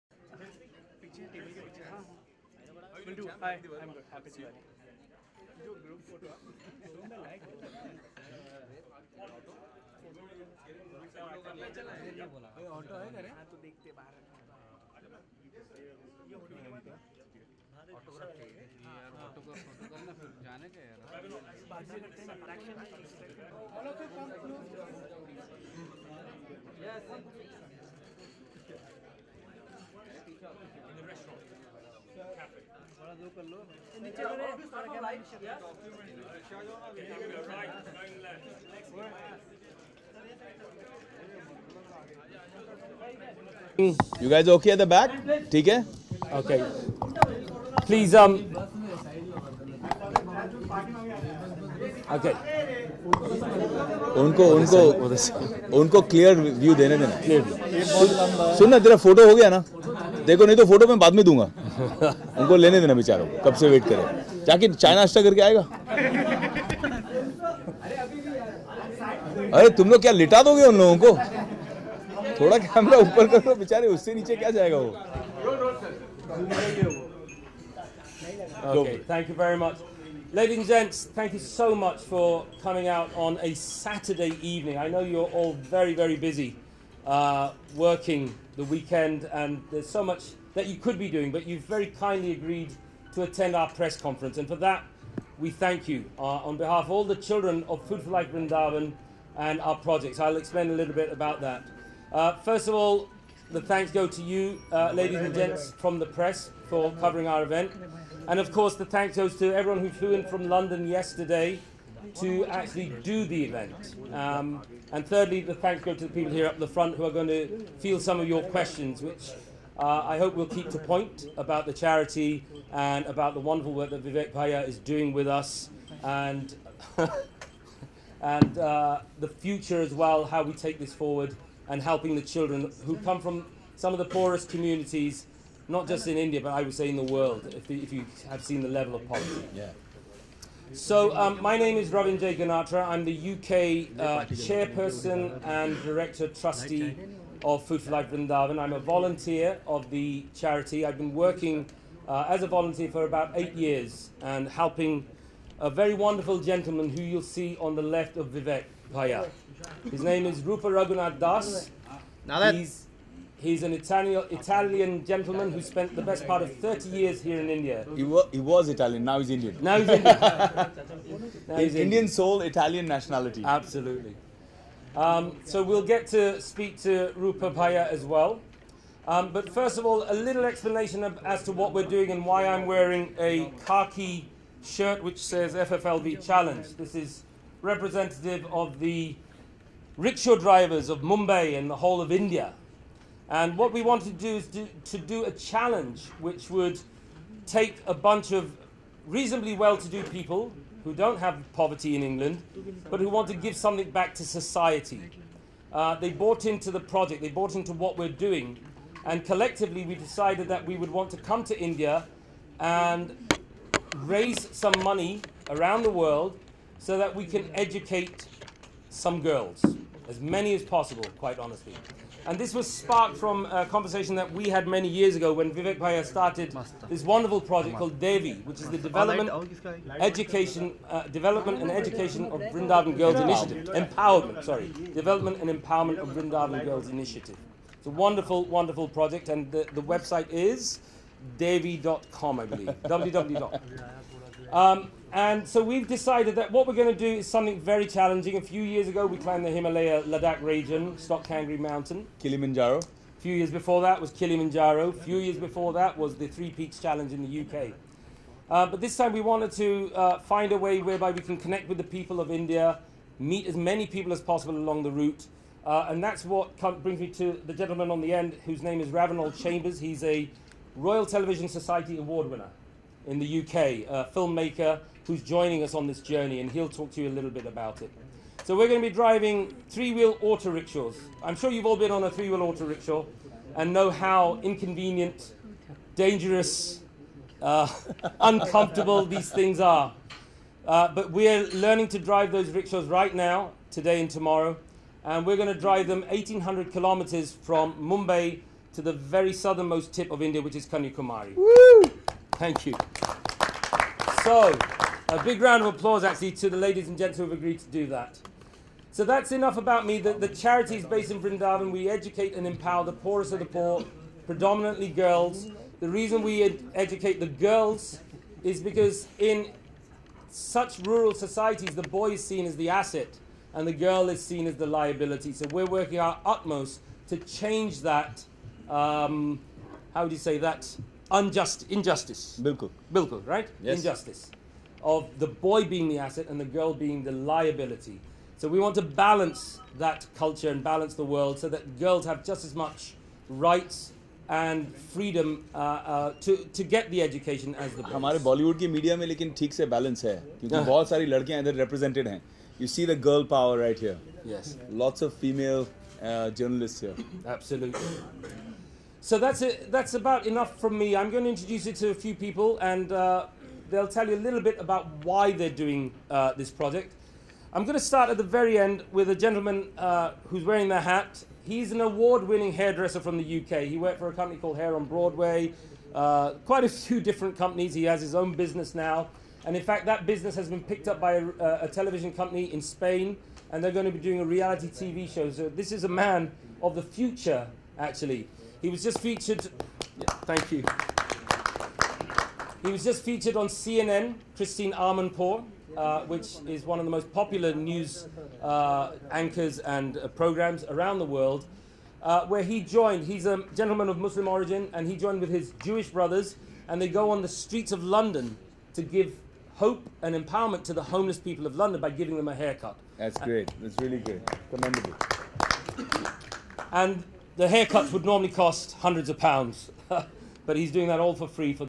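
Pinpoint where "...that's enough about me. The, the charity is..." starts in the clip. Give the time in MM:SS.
05:09.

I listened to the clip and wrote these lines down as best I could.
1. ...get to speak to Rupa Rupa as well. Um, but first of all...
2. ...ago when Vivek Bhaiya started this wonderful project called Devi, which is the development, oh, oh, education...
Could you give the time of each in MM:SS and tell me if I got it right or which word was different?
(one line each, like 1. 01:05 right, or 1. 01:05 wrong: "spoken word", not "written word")
1. 02:55 wrong: "Bhaiya", not "Rupa"
2. 03:45 right.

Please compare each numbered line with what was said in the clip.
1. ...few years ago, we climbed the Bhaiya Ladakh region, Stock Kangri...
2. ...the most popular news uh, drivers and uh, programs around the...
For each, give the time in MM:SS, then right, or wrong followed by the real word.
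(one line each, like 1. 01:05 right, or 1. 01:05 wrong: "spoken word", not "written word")
1. 04:08 wrong: "Himalaya", not "Bhaiya"
2. 06:36 wrong: "anchors", not "drivers".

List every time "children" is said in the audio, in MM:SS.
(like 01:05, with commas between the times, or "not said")
01:37, 02:12.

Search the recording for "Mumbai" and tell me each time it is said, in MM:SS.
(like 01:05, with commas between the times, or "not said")
03:11, 04:57.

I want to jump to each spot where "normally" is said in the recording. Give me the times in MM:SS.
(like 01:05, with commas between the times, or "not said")
06:58.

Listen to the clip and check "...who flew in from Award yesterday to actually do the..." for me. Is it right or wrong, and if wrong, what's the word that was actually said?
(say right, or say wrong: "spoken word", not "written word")
wrong: "London", not "Award".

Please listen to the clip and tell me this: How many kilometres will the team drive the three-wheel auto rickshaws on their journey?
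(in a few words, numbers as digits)
1,800.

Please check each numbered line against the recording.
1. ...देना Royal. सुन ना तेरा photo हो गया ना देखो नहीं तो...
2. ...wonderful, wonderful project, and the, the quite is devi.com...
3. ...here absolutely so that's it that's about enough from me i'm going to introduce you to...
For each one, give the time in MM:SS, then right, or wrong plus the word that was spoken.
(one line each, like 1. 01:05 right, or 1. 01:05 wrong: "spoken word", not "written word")
1. 00:56 wrong: "Clear", not "Royal"
2. 03:57 wrong: "website", not "quite"
3. 05:56 right.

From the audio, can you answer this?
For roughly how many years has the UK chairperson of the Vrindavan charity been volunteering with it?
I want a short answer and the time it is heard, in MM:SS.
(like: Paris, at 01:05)
8 years, at 02:33.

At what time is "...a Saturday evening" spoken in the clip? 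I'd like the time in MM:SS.
01:23.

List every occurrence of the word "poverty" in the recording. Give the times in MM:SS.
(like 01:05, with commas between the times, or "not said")
02:19, 03:21.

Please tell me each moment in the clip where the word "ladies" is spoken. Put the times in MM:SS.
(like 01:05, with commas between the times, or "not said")
01:20, 01:44, 05:06.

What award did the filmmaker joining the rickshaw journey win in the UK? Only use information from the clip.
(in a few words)
Royal Television Society Award.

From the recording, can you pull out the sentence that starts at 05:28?
Um, how would you say that?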